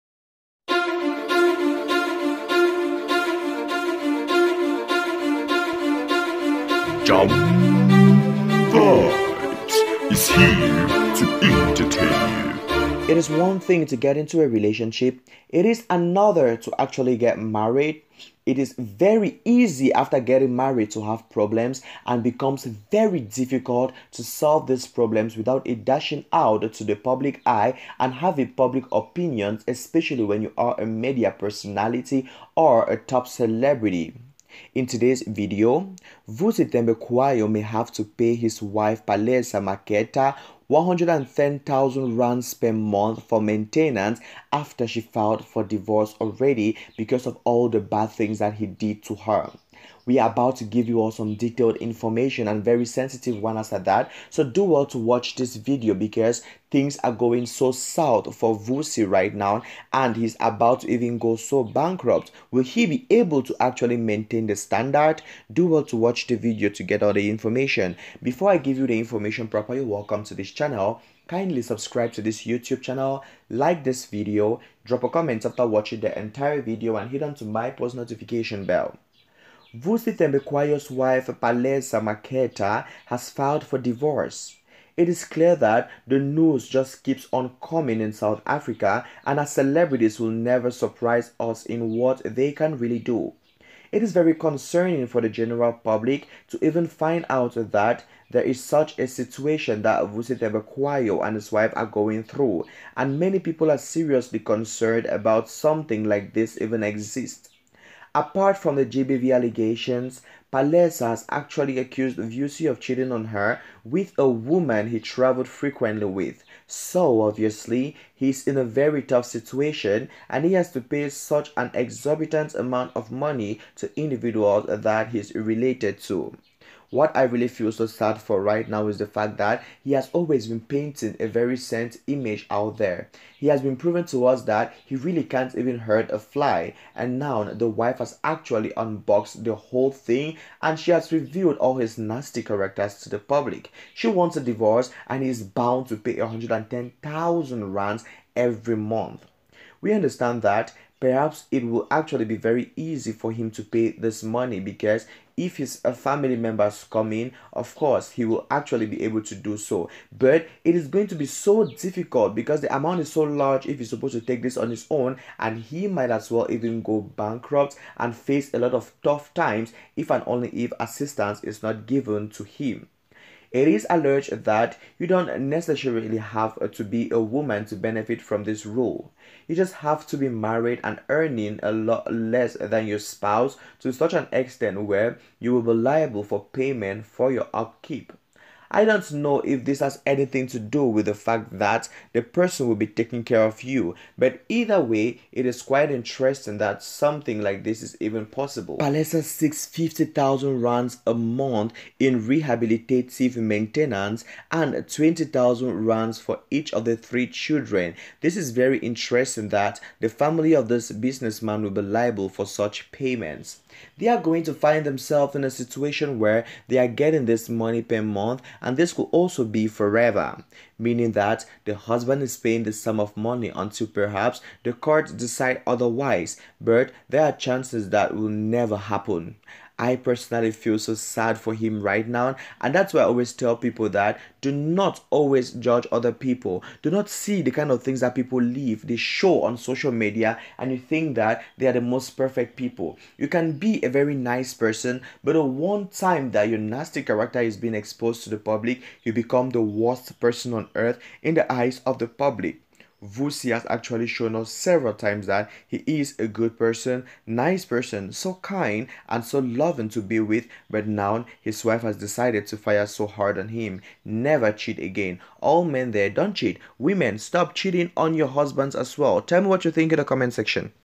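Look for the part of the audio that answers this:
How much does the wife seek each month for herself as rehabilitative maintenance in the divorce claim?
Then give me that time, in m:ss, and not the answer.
3:19.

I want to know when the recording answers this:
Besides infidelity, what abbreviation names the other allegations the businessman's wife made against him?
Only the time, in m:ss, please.
1:48.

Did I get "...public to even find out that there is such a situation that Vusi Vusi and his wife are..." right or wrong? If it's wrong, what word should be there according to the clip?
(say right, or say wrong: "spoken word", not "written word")
wrong: "Thembekwayo", not "Vusi".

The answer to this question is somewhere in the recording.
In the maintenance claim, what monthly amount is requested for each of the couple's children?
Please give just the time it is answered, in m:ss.
3:24.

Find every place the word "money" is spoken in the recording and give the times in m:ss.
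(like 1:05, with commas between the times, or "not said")
2:03, 2:34, 3:37, 3:43.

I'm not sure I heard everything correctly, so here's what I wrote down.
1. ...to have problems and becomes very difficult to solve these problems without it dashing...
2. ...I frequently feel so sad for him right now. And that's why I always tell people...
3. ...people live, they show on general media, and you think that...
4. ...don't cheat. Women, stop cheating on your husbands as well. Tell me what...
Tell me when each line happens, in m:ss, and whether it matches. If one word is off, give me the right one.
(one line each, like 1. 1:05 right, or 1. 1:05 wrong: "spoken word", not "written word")
1. 0:20 right
2. 3:49 wrong: "personally", not "frequently"
3. 3:58 wrong: "social", not "general"
4. 4:26 right.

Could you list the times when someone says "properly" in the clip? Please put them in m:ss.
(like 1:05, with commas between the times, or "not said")
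1:09.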